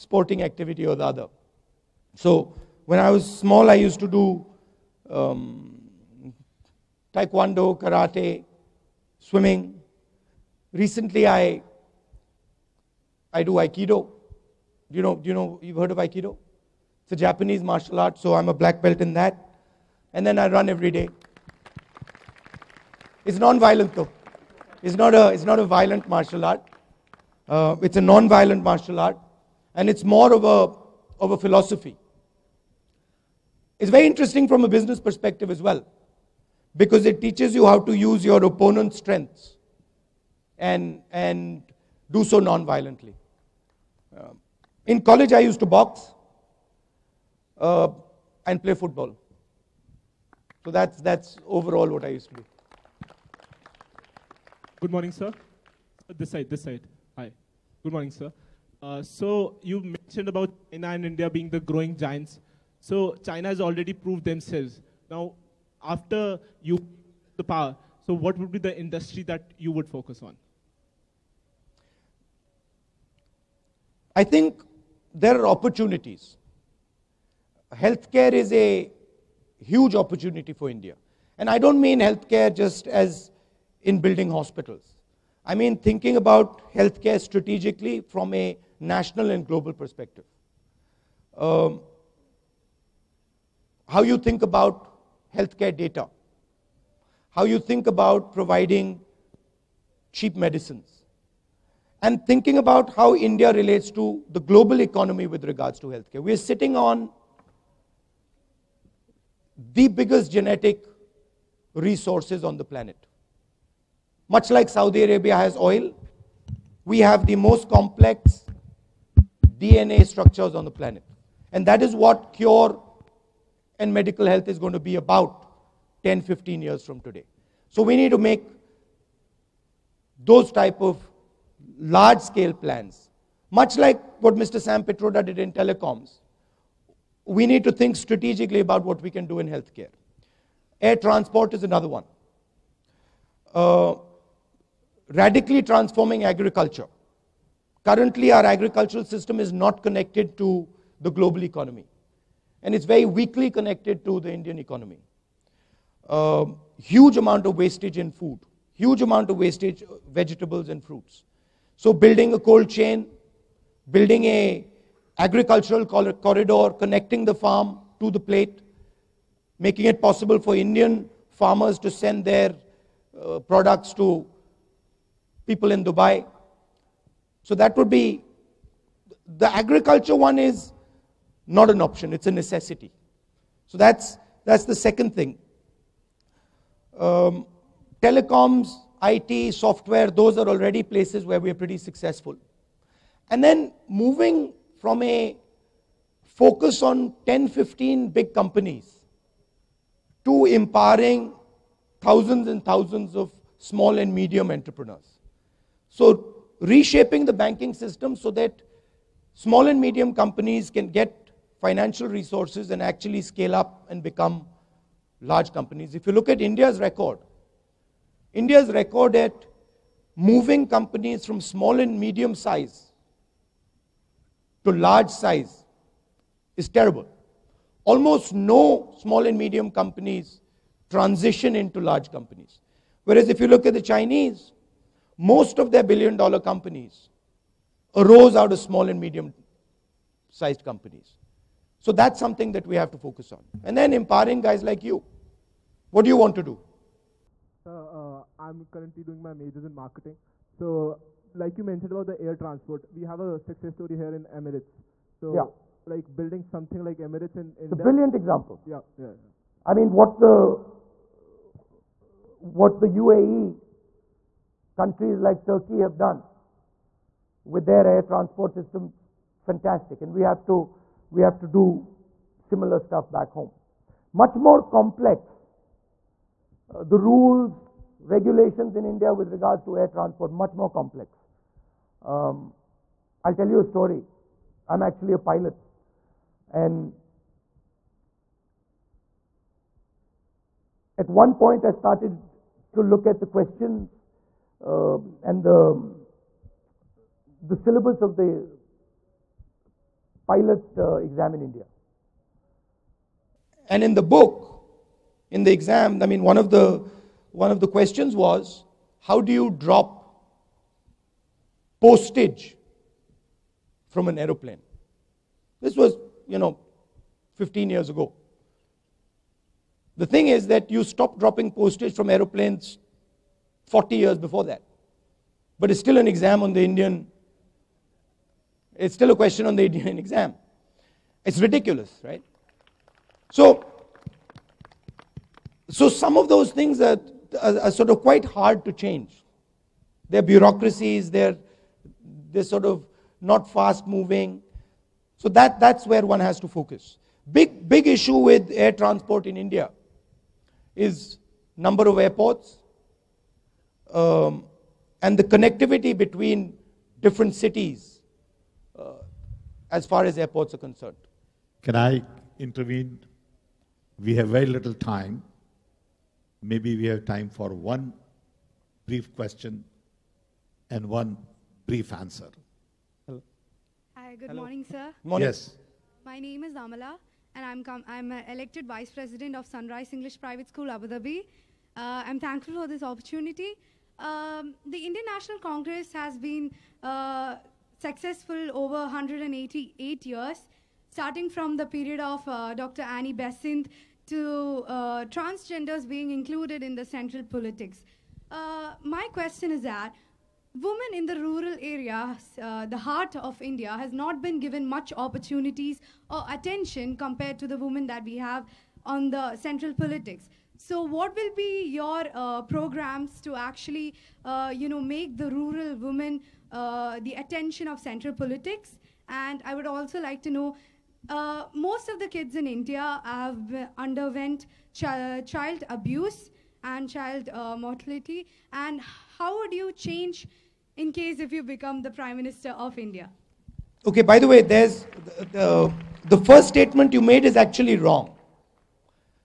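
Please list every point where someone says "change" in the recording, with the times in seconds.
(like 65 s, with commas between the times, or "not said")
338 s, 429 s.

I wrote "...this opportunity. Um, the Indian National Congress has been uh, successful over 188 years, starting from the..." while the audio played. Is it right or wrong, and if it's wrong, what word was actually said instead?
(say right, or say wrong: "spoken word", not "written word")
right.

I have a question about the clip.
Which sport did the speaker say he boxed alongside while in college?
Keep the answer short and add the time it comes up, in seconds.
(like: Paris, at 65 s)
Football, at 48 s.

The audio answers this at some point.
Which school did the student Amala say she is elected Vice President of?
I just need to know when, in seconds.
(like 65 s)
379 s.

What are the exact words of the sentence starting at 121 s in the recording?
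And that is what cure and medical health is going to be about 10, 15 years from today.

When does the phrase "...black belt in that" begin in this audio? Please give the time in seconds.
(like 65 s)
18 s.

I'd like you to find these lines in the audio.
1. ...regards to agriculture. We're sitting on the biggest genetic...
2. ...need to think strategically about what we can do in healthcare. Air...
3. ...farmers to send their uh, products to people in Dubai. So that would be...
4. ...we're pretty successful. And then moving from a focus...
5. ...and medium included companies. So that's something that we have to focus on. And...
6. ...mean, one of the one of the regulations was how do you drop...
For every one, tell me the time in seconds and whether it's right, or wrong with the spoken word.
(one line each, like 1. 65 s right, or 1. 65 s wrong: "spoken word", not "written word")
1. 105 s wrong: "healthcare", not "agriculture"
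2. 137 s right
3. 171 s right
4. 191 s right
5. 238 s wrong: "sized", not "included"
6. 306 s wrong: "questions", not "regulations".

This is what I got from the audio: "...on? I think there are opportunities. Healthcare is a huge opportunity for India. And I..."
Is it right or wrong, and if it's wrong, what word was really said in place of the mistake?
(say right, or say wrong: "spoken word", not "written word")
right.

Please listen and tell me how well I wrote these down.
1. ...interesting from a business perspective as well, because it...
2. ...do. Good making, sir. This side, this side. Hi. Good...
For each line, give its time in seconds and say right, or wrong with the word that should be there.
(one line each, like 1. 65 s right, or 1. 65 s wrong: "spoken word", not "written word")
1. 34 s right
2. 52 s wrong: "morning", not "making".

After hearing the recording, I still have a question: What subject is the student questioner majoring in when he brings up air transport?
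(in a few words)
Marketing.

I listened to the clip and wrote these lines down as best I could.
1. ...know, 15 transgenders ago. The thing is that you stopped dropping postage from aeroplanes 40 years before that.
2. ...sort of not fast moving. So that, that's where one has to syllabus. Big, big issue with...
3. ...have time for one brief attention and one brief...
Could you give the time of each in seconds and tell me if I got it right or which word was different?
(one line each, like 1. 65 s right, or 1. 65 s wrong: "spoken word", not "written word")
1. 316 s wrong: "years", not "transgenders"
2. 342 s wrong: "focus", not "syllabus"
3. 366 s wrong: "question", not "attention".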